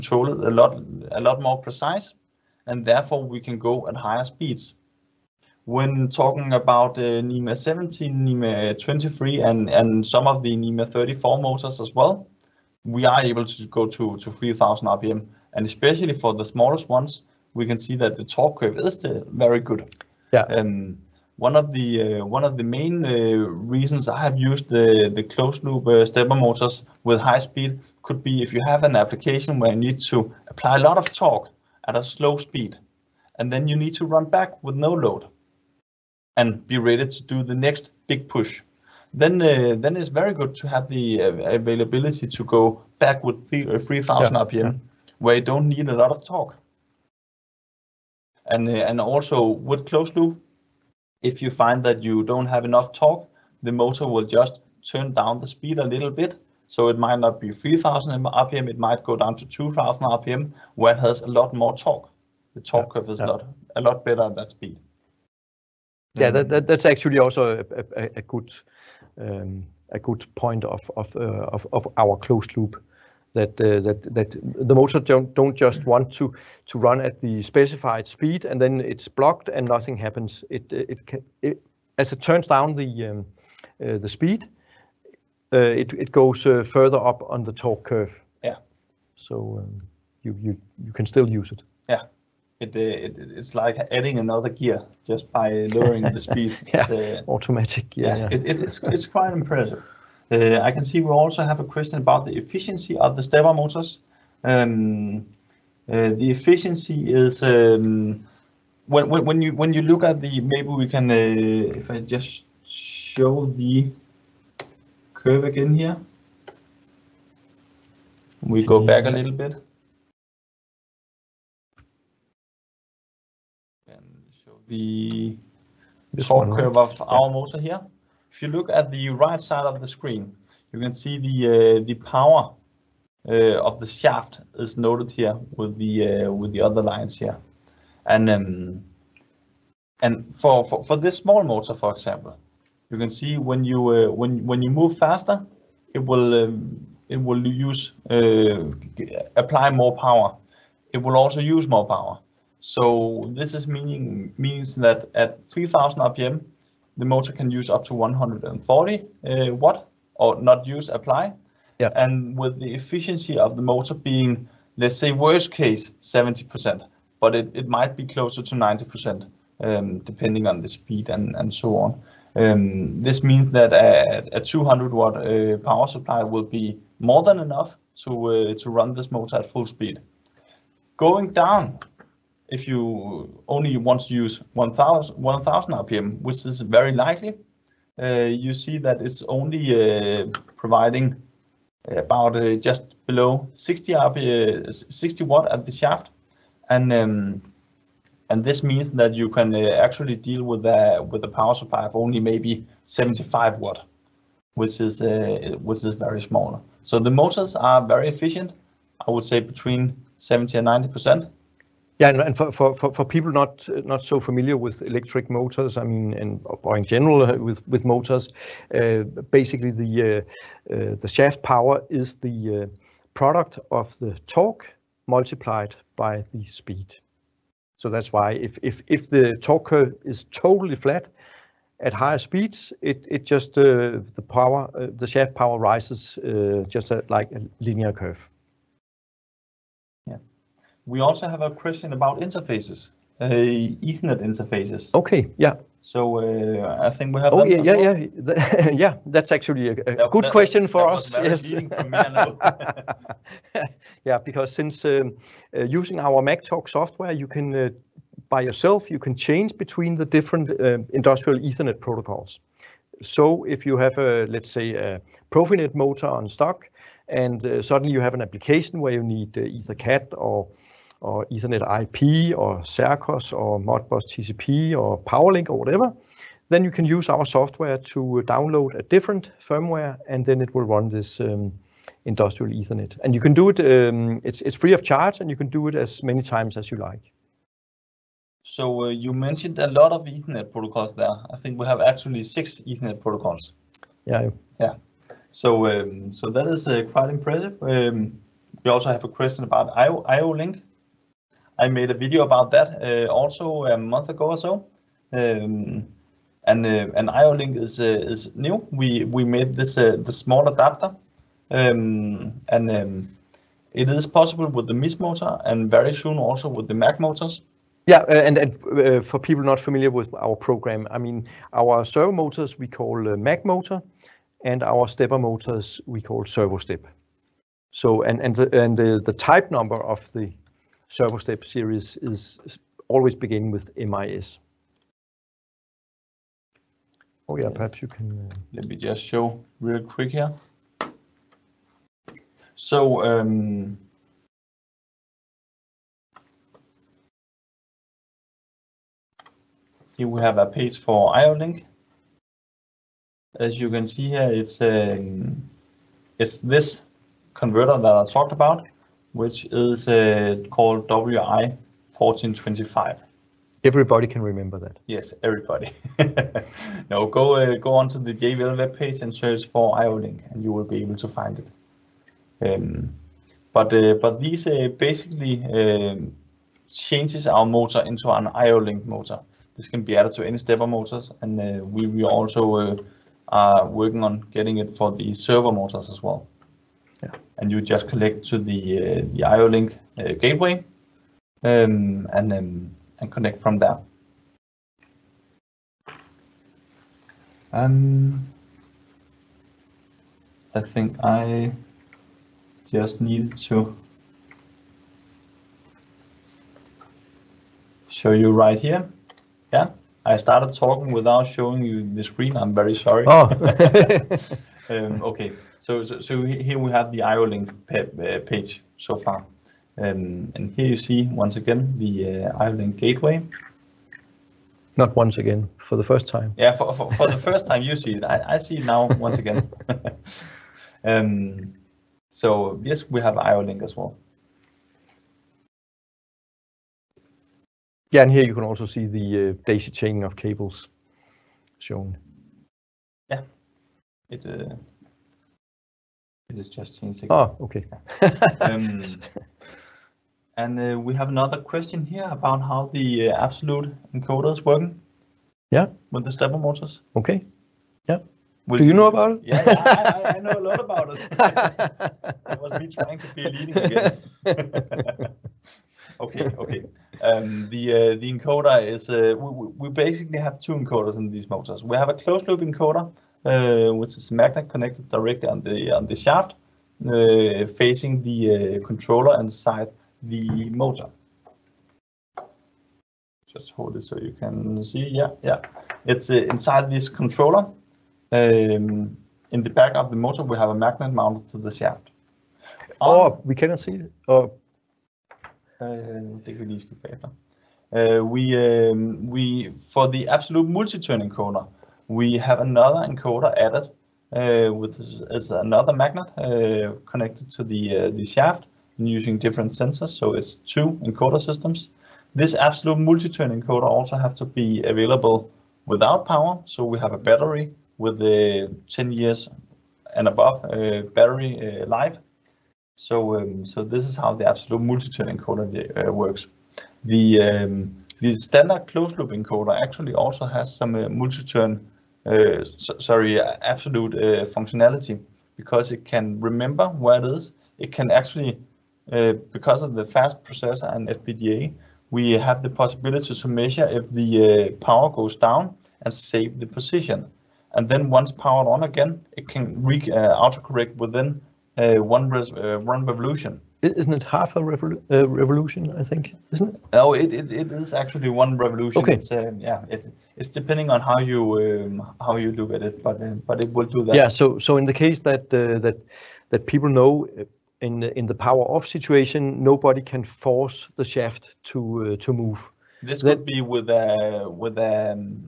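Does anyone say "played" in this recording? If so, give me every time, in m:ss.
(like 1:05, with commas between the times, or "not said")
not said.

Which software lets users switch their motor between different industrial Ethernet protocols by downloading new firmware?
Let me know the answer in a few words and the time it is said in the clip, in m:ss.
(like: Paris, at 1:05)
MacTalk, at 4:16.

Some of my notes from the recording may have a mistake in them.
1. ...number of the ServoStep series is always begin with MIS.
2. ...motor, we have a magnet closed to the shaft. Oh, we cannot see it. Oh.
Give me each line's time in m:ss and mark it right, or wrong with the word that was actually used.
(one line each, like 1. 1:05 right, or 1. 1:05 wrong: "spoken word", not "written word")
1. 5:29 right
2. 8:09 wrong: "mounted", not "closed".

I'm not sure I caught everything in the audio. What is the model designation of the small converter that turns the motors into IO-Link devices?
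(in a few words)
WI 1425.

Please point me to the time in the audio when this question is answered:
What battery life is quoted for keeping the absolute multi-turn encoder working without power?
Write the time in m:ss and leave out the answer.
8:38.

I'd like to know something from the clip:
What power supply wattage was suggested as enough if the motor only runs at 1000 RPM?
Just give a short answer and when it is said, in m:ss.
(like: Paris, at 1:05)
75 watt, at 3:22.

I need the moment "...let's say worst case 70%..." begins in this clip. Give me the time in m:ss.
2:44.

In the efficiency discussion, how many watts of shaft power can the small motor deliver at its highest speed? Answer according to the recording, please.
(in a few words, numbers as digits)
140 watts.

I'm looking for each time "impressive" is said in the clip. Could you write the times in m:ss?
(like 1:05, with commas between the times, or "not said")
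1:39, 4:57.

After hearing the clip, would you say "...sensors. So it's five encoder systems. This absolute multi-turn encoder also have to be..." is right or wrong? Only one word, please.
wrong.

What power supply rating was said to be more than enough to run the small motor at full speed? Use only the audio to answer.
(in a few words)
200 watt.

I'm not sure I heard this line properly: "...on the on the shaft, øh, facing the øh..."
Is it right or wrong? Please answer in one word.
right.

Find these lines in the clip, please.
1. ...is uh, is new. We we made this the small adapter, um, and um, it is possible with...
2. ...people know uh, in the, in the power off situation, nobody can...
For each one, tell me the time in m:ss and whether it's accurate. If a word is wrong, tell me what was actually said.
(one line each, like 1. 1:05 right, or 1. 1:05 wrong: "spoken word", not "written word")
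1. 5:07 right
2. 9:26 right.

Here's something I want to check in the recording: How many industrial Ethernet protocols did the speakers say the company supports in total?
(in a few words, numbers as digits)
6.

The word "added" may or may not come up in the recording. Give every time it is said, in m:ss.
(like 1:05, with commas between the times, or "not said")
6:19, 8:23.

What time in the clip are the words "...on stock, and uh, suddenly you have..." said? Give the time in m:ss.
4:26.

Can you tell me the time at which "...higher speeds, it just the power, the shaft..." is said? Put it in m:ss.
3:51.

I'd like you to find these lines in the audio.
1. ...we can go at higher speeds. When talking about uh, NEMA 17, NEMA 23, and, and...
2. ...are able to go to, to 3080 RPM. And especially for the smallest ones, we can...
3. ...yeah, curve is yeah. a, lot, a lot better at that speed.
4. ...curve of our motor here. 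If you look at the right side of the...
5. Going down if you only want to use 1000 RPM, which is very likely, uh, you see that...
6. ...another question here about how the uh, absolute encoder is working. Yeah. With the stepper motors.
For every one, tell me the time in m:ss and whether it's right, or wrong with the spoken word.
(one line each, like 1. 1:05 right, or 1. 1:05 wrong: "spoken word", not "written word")
1. 0:03 right
2. 0:13 wrong: "3000", not "3080"
3. 1:02 right
4. 2:06 right
5. 3:00 right
6. 7:31 right.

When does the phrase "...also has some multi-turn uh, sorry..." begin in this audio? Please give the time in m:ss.
8:49.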